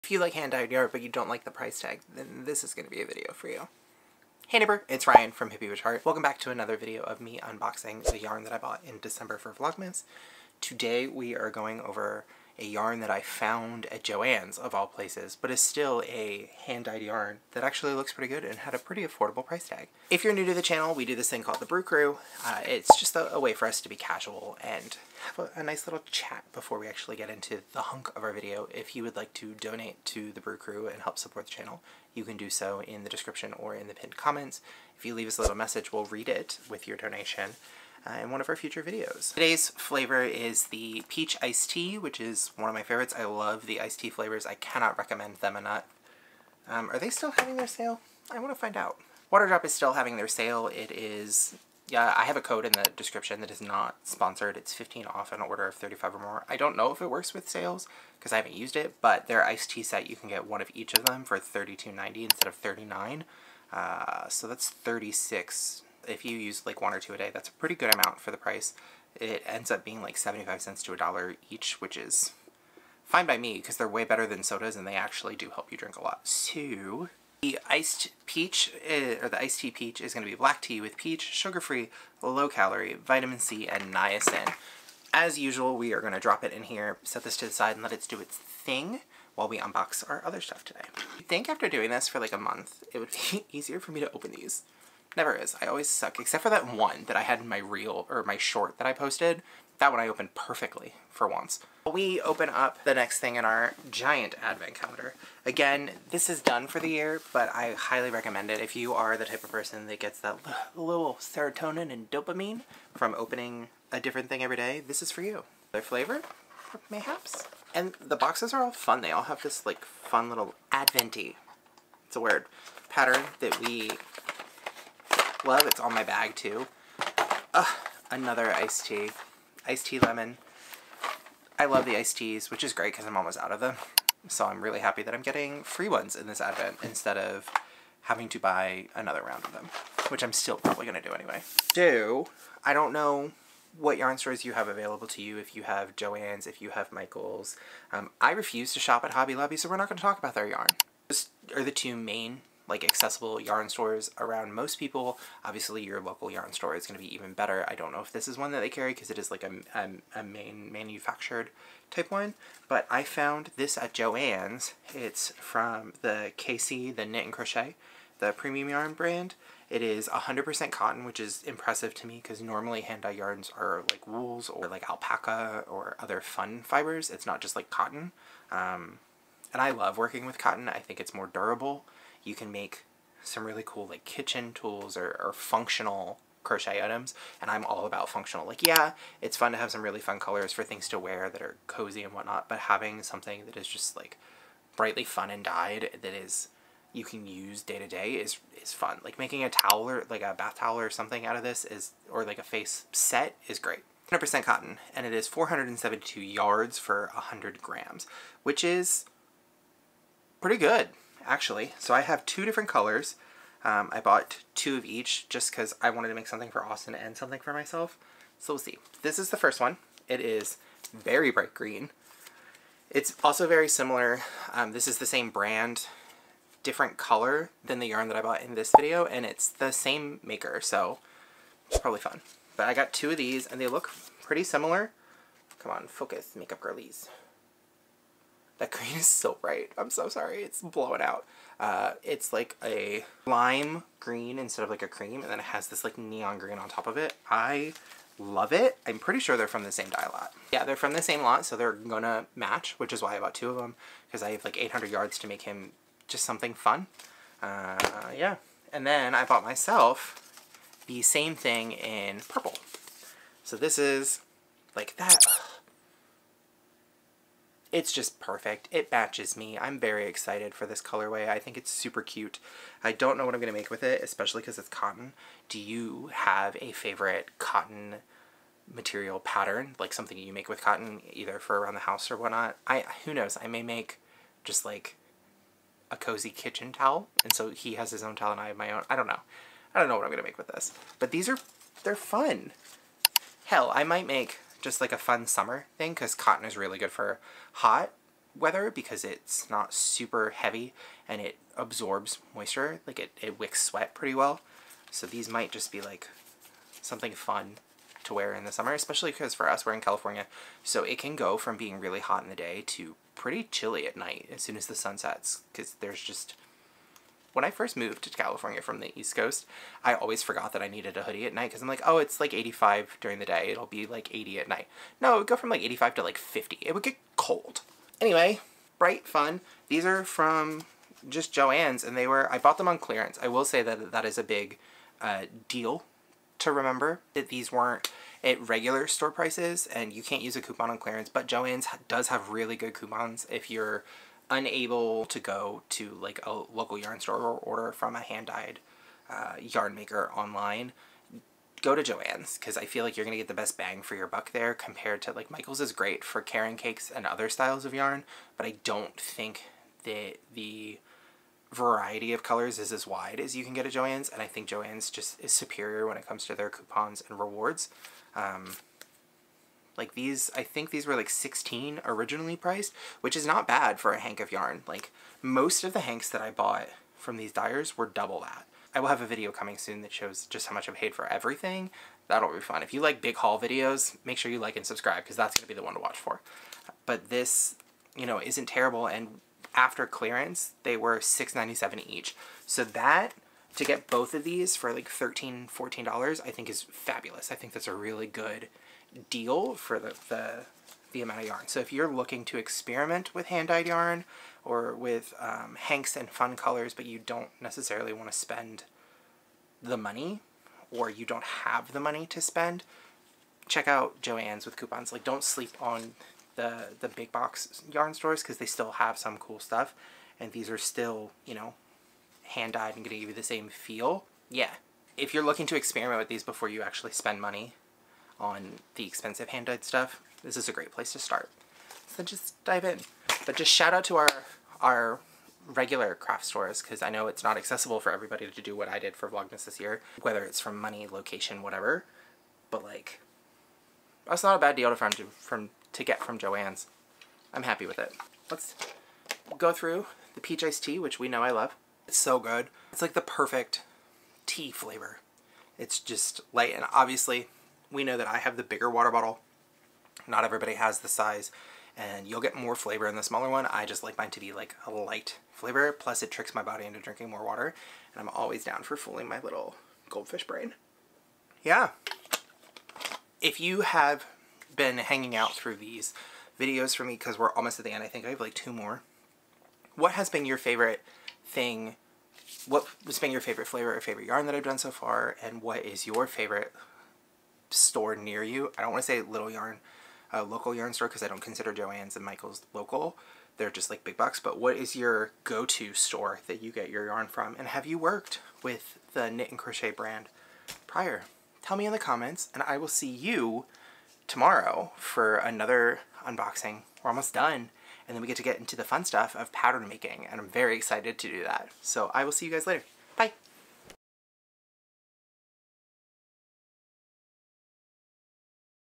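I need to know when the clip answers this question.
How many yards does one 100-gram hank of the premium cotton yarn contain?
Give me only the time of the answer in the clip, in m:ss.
3:25.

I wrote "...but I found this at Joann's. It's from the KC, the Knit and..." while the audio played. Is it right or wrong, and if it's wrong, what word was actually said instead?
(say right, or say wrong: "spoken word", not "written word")
right.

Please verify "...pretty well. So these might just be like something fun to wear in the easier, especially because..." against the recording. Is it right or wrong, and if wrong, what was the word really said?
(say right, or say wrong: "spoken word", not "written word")
wrong: "summer", not "easier".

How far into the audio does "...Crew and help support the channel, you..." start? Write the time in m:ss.
0:30.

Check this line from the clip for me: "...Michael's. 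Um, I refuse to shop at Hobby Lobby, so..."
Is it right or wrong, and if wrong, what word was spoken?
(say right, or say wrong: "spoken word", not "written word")
right.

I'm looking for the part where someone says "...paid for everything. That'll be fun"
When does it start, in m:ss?
6:20.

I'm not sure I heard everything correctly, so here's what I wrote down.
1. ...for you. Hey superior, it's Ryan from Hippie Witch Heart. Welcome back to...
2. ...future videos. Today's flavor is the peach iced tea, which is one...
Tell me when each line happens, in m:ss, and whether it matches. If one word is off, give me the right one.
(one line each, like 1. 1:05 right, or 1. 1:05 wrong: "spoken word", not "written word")
1. 0:03 wrong: "neighbor", not "superior"
2. 0:38 right.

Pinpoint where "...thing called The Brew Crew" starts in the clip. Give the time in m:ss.
0:21.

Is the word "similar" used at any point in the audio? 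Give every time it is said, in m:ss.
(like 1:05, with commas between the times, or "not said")
3:43, 3:54.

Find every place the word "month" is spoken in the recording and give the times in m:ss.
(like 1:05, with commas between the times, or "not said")
1:32.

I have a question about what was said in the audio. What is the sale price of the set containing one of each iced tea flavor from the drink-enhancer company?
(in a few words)
$32.90.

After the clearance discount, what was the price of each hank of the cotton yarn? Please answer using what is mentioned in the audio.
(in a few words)
$6.97.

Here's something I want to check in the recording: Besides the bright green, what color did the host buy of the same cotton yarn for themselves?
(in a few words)
Purple.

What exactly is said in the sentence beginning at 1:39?
That one I opened perfectly, for once.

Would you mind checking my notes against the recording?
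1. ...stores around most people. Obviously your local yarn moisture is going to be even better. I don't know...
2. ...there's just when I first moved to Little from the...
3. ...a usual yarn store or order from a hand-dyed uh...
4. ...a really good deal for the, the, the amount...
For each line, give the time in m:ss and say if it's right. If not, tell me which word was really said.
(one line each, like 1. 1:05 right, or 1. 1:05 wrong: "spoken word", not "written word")
1. 2:33 wrong: "store", not "moisture"
2. 5:15 wrong: "California", not "Little"
3. 5:46 wrong: "local", not "usual"
4. 6:37 right.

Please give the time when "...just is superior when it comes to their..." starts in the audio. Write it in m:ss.
6:04.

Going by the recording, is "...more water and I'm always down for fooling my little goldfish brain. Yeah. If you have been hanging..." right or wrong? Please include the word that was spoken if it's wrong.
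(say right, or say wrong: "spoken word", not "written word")
right.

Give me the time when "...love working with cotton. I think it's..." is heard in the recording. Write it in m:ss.
2:59.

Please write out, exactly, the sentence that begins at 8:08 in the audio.
I don't want to say Little Yarn, uh, local yarn store, because I don't consider Joann's and Michael's local.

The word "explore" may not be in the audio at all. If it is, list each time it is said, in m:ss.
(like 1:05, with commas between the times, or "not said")
not said.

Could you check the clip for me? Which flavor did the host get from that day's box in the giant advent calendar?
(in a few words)
Iced tea lemon.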